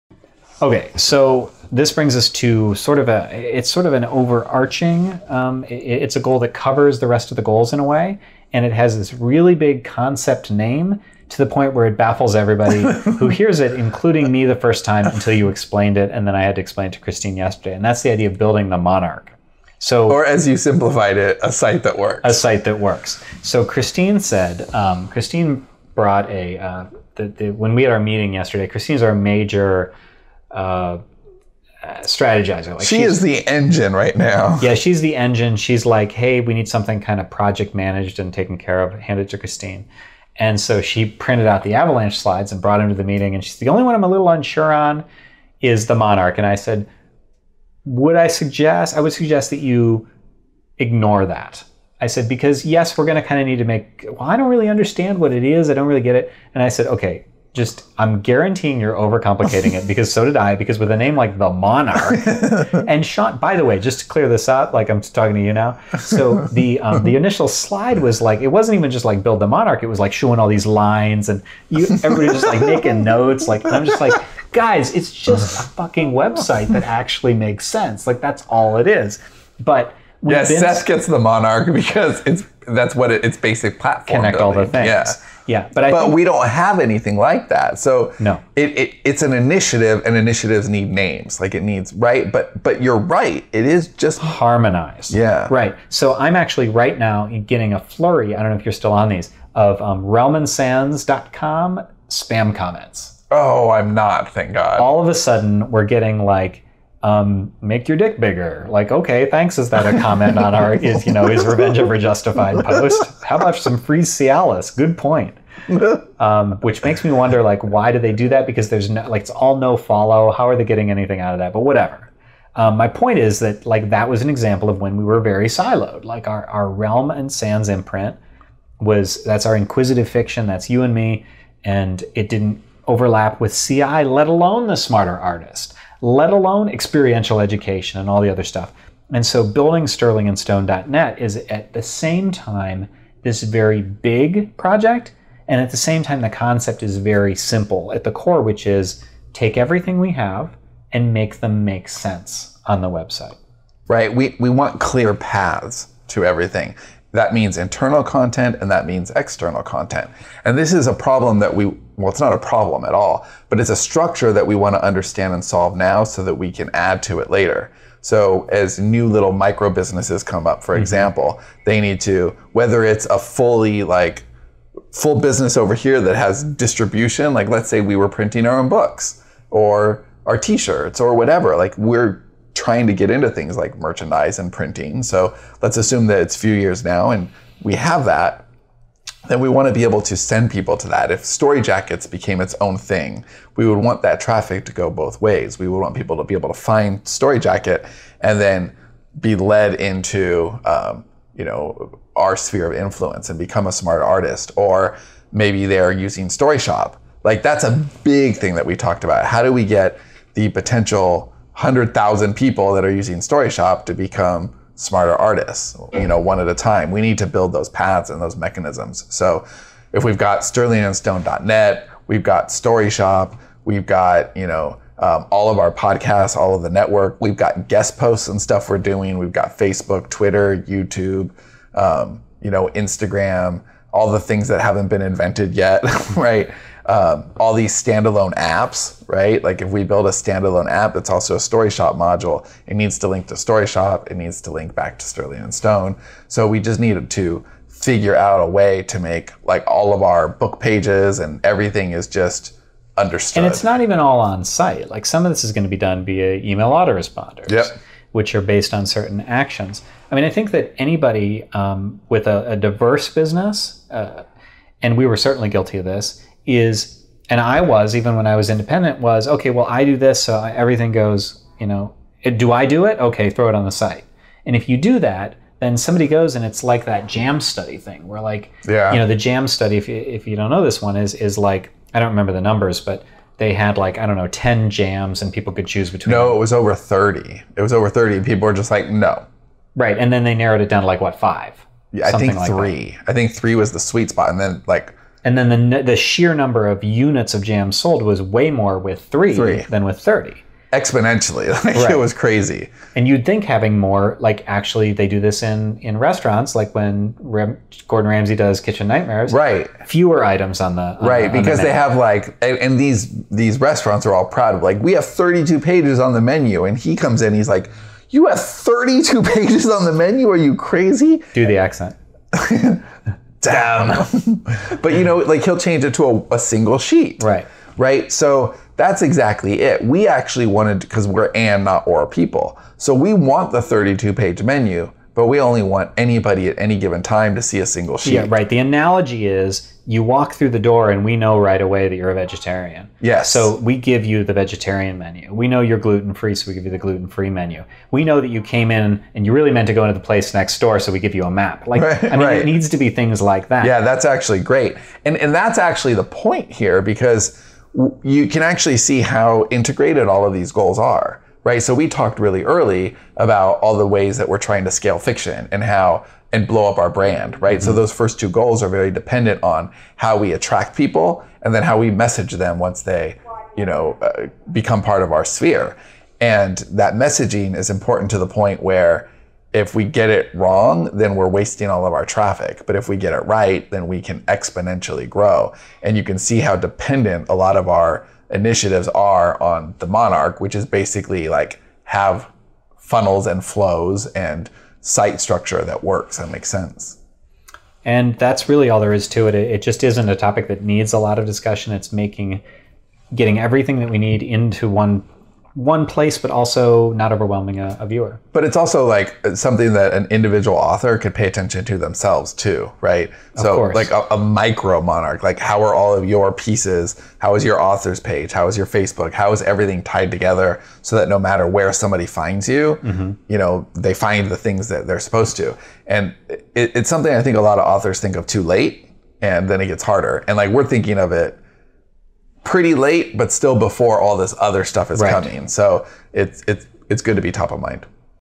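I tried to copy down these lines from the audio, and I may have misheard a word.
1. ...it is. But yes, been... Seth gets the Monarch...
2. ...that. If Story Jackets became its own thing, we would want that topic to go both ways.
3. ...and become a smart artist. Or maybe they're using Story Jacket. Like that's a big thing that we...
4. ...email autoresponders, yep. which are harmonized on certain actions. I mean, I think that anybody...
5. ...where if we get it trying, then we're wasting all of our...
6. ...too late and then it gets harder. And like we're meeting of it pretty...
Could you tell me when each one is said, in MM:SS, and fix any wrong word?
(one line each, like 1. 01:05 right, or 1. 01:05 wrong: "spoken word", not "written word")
1. 01:18 right
2. 03:10 wrong: "traffic", not "topic"
3. 03:23 wrong: "Shop", not "Jacket"
4. 04:16 wrong: "based", not "harmonized"
5. 06:18 wrong: "wrong", not "trying"
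6. 07:08 wrong: "thinking", not "meeting".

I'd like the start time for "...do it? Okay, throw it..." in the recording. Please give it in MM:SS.
04:32.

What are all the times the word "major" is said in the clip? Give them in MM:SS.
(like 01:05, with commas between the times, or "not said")
00:29.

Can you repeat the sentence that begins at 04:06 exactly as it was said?
So we just needed to figure out a way to make like all of our book pages and everything is just understood.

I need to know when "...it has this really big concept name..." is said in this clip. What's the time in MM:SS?
00:08.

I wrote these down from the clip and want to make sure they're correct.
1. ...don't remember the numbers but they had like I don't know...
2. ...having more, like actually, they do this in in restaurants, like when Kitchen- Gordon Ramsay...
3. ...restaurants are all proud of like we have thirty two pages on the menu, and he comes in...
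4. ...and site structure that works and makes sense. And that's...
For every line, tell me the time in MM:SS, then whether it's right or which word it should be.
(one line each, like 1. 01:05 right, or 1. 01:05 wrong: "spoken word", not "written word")
1. 04:41 right
2. 05:03 wrong: "Ram", not "Kitchen"
3. 05:13 right
4. 06:34 right.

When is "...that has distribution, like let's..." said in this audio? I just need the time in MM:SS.
02:56.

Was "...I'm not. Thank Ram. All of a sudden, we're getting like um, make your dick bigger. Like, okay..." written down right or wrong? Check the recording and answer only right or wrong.
wrong.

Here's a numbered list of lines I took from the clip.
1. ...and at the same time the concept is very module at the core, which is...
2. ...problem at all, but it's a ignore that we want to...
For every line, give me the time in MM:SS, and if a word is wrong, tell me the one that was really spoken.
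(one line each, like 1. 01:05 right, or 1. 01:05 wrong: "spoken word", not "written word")
1. 02:25 wrong: "simple", not "module"
2. 02:42 wrong: "structure", not "ignore".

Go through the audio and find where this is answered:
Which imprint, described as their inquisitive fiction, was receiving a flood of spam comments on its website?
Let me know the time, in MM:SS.
02:06.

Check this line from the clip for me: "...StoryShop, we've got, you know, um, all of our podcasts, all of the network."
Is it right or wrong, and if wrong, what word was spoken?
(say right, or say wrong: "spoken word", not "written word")
right.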